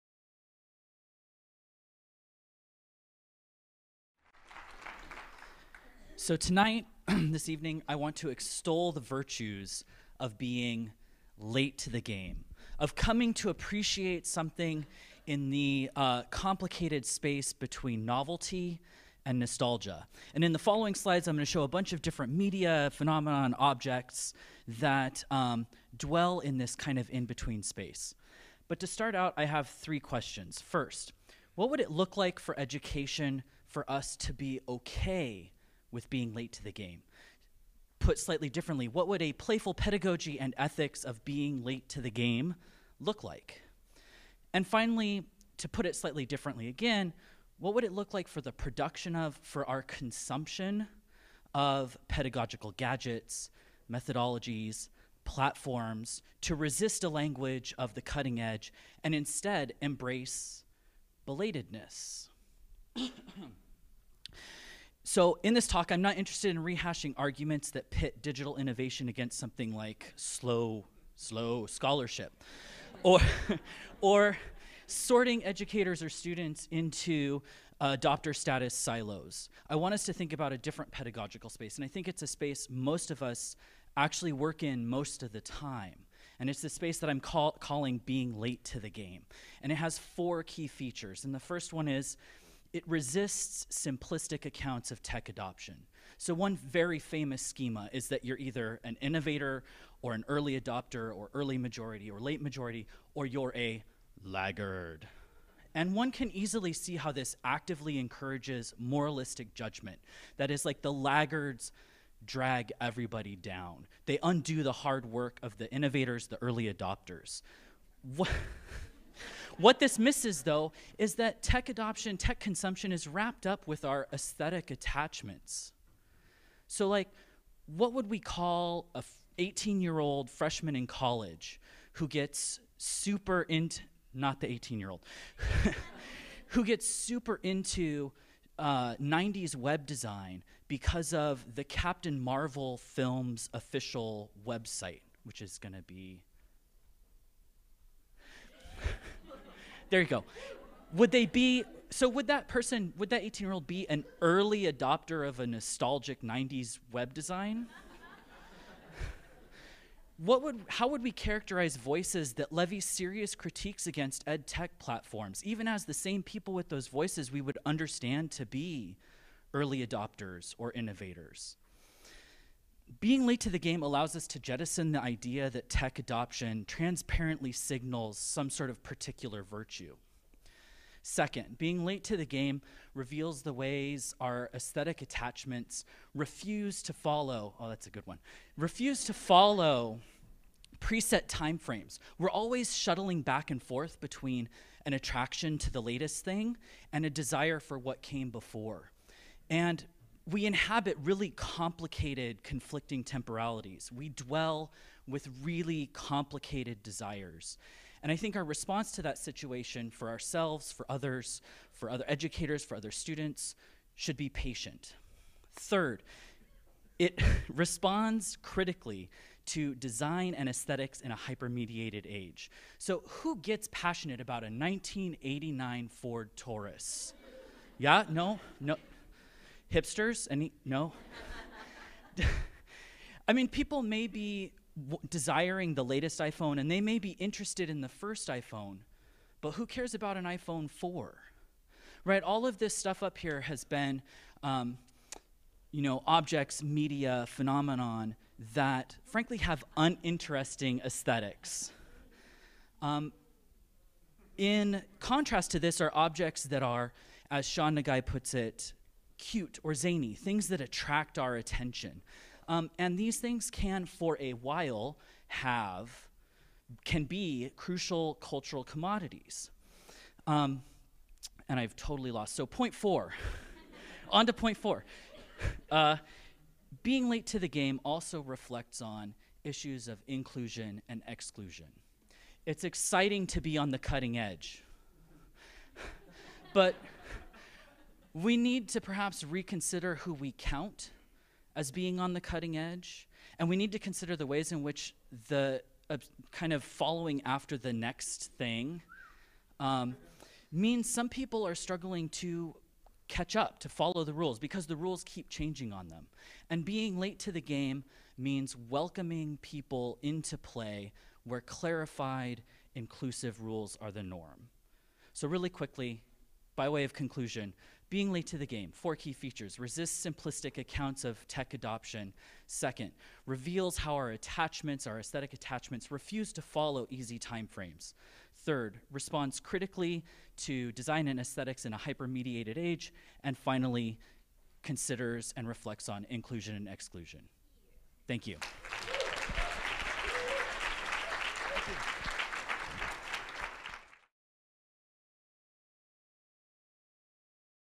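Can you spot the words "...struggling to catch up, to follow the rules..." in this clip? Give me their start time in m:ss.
5:01.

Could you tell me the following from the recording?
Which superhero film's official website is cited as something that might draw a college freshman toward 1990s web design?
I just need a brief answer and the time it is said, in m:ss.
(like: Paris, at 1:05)
Captain Marvel, at 2:21.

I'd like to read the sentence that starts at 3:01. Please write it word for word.
Second, being late to the game reveals the ways our aesthetic attachments refuse to follow.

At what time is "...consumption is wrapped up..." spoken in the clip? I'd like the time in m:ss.
2:02.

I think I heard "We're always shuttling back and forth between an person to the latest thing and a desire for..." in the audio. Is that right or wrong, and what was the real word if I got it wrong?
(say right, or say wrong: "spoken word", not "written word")
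wrong: "attraction", not "person".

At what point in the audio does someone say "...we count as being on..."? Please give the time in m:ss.
4:50.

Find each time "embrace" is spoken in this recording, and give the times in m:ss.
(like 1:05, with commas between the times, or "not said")
0:59.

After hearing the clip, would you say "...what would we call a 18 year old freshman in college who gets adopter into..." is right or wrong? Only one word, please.
wrong.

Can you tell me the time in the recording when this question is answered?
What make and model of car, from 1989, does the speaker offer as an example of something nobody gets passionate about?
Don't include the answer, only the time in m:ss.
3:45.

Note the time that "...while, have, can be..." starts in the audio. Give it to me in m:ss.
4:24.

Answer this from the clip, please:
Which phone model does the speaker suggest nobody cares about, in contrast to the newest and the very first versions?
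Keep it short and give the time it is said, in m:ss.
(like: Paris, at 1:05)
iPhone 4, at 4:00.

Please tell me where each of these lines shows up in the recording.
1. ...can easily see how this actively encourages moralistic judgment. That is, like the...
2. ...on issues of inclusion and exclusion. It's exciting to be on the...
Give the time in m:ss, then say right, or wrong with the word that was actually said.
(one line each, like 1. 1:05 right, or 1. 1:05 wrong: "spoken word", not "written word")
1. 1:46 right
2. 4:38 right.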